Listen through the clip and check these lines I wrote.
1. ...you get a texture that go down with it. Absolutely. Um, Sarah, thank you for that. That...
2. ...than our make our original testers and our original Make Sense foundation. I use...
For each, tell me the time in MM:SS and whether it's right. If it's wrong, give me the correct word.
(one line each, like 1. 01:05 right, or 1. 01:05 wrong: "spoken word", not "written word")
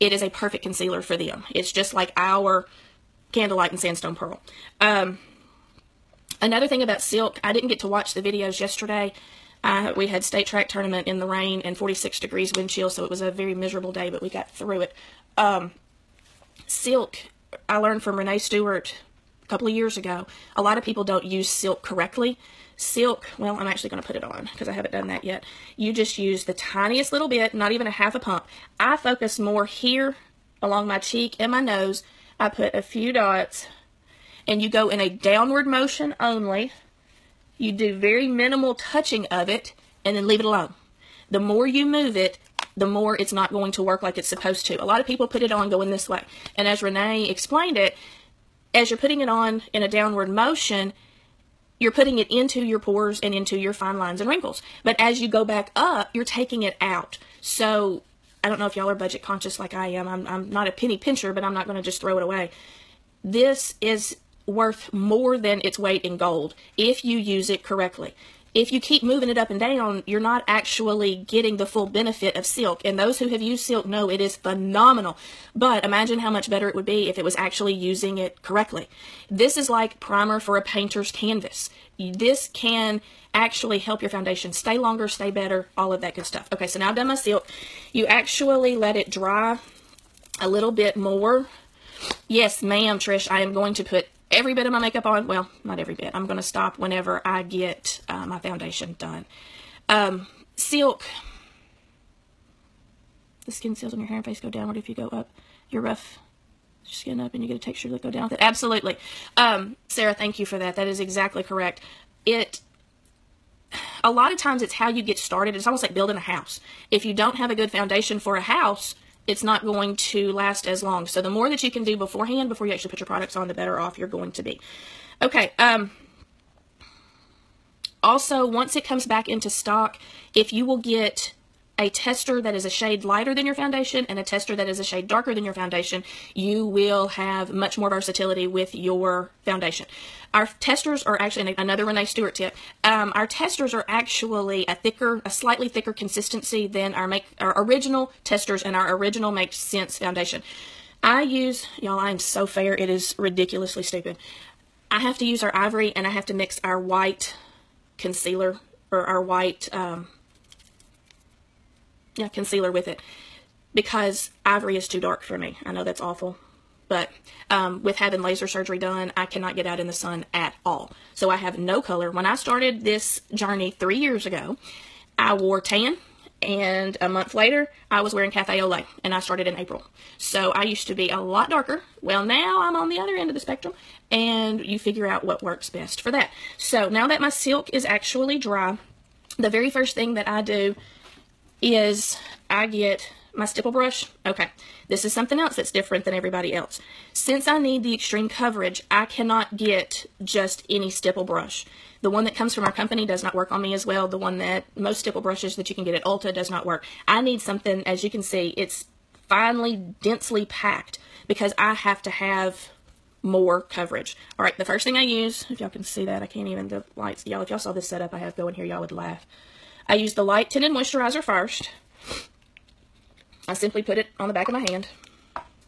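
1. 01:47 right
2. 02:26 right.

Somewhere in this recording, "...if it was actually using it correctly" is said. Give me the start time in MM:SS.
01:17.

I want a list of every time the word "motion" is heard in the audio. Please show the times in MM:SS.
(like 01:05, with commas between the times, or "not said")
00:35, 00:50.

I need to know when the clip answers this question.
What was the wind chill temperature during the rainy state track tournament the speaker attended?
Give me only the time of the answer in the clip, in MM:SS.
00:11.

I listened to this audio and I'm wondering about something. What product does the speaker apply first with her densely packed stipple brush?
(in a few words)
light tinted moisturizer.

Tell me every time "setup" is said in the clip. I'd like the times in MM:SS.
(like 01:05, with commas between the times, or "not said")
03:37.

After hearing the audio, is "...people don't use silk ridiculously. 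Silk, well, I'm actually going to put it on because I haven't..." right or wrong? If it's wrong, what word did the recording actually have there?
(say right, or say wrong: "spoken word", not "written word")
wrong: "correctly", not "ridiculously".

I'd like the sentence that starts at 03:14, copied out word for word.
Okay, this is something else that's different than everybody else.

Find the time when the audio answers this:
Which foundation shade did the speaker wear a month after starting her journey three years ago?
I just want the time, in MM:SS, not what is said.
02:58.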